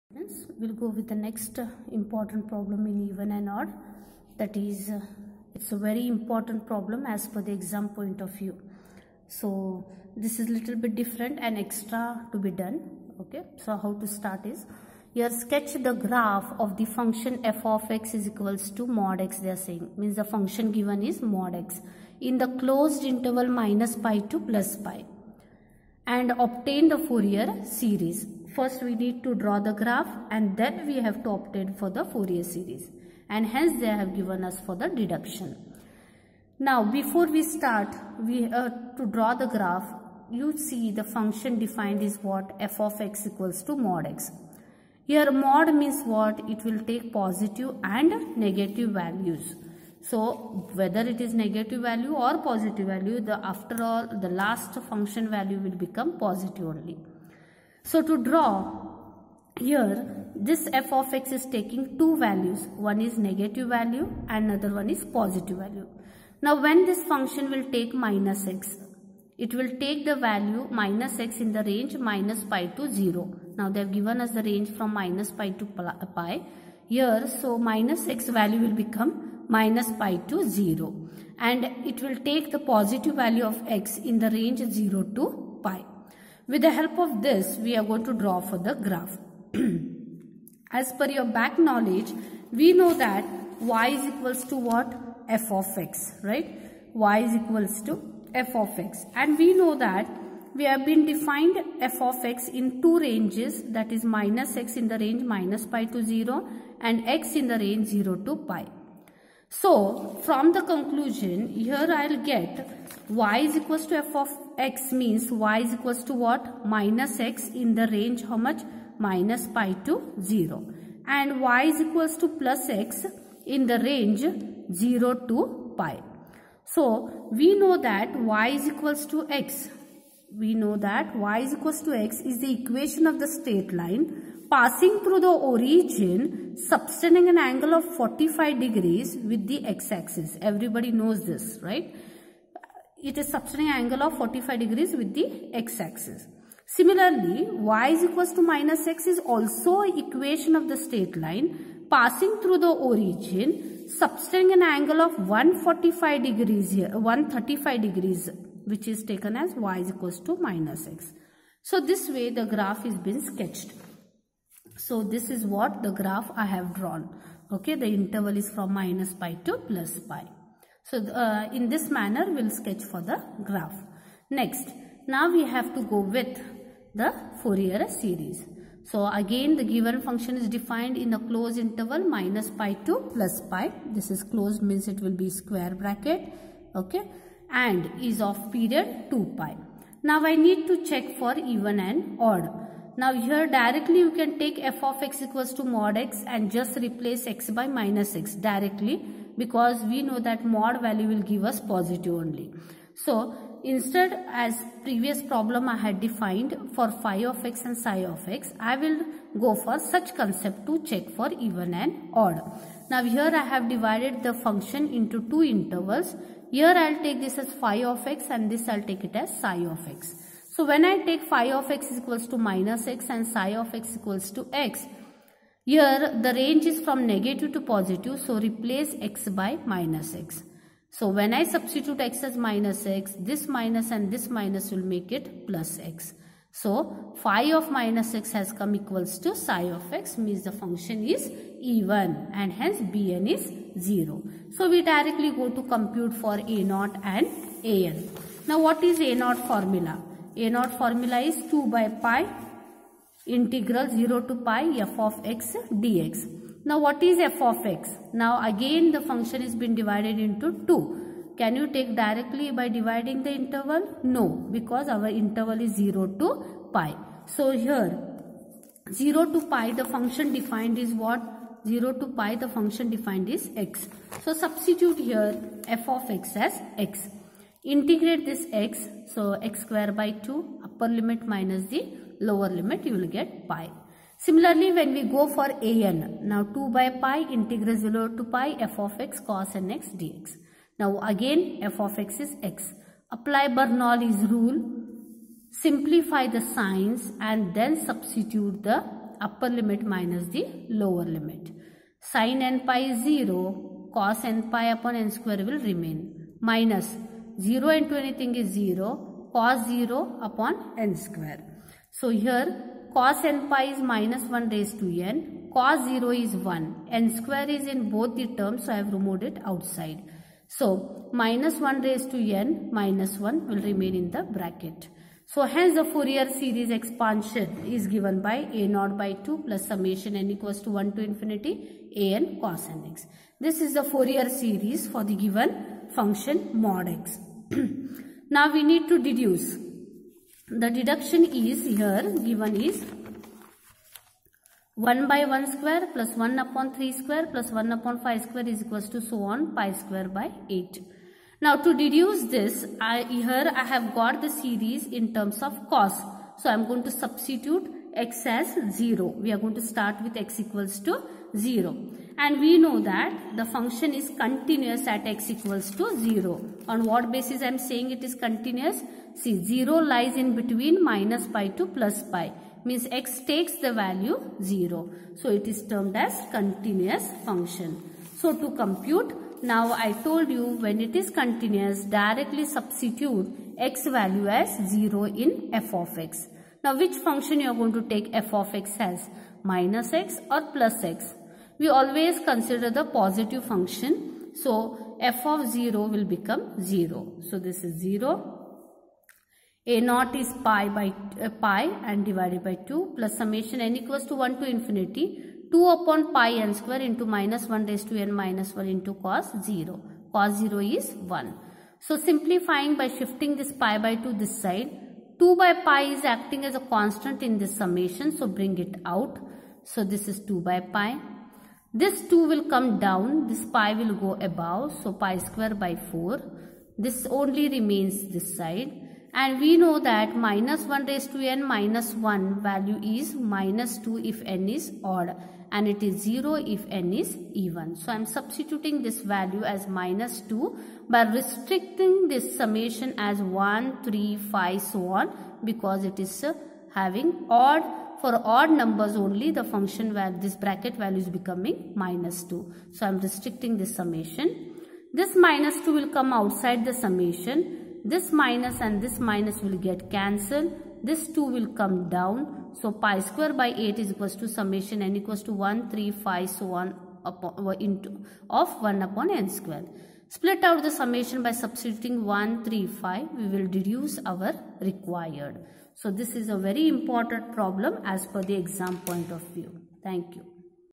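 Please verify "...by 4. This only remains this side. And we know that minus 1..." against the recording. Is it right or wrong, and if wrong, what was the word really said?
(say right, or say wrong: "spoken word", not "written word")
right.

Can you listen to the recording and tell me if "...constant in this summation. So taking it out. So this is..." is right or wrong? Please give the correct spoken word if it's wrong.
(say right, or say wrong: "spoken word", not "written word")
wrong: "bring", not "taking".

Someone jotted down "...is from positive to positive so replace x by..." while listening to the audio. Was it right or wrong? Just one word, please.
wrong.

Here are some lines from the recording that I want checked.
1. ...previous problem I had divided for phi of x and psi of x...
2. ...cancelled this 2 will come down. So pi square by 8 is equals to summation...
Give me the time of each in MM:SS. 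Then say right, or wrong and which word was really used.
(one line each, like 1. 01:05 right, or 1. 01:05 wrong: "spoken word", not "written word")
1. 03:24 wrong: "defined", not "divided"
2. 07:39 right.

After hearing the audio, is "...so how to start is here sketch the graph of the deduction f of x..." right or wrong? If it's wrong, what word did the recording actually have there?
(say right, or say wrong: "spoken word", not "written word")
wrong: "function", not "deduction".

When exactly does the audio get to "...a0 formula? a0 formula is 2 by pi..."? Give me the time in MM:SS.
04:08.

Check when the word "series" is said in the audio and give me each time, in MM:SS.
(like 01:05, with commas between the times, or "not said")
00:27, 00:32, 02:57, 05:26, 05:34, 05:54.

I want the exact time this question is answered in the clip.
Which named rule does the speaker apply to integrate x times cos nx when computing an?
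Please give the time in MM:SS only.
04:53.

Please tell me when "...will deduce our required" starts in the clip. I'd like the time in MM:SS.
07:53.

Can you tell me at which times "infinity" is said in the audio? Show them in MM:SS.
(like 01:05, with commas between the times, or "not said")
05:31, 06:44.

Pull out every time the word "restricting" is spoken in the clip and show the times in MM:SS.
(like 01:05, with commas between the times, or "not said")
07:21, 07:32.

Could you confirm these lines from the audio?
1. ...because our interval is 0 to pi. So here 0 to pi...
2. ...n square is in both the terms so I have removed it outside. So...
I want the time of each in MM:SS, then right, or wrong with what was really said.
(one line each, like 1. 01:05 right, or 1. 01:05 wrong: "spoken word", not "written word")
1. 04:24 right
2. 05:16 right.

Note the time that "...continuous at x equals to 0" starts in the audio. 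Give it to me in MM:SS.
06:04.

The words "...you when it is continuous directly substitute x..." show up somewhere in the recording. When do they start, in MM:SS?
06:20.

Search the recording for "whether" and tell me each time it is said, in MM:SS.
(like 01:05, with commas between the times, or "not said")
00:50.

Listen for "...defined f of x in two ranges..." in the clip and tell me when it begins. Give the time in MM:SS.
01:41.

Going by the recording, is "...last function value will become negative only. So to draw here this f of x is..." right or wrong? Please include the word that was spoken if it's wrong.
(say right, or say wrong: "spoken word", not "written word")
wrong: "positive", not "negative".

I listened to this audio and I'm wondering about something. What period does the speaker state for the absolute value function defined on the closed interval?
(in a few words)
2 pi.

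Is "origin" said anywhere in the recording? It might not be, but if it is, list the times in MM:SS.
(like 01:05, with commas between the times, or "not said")
02:15, 02:32.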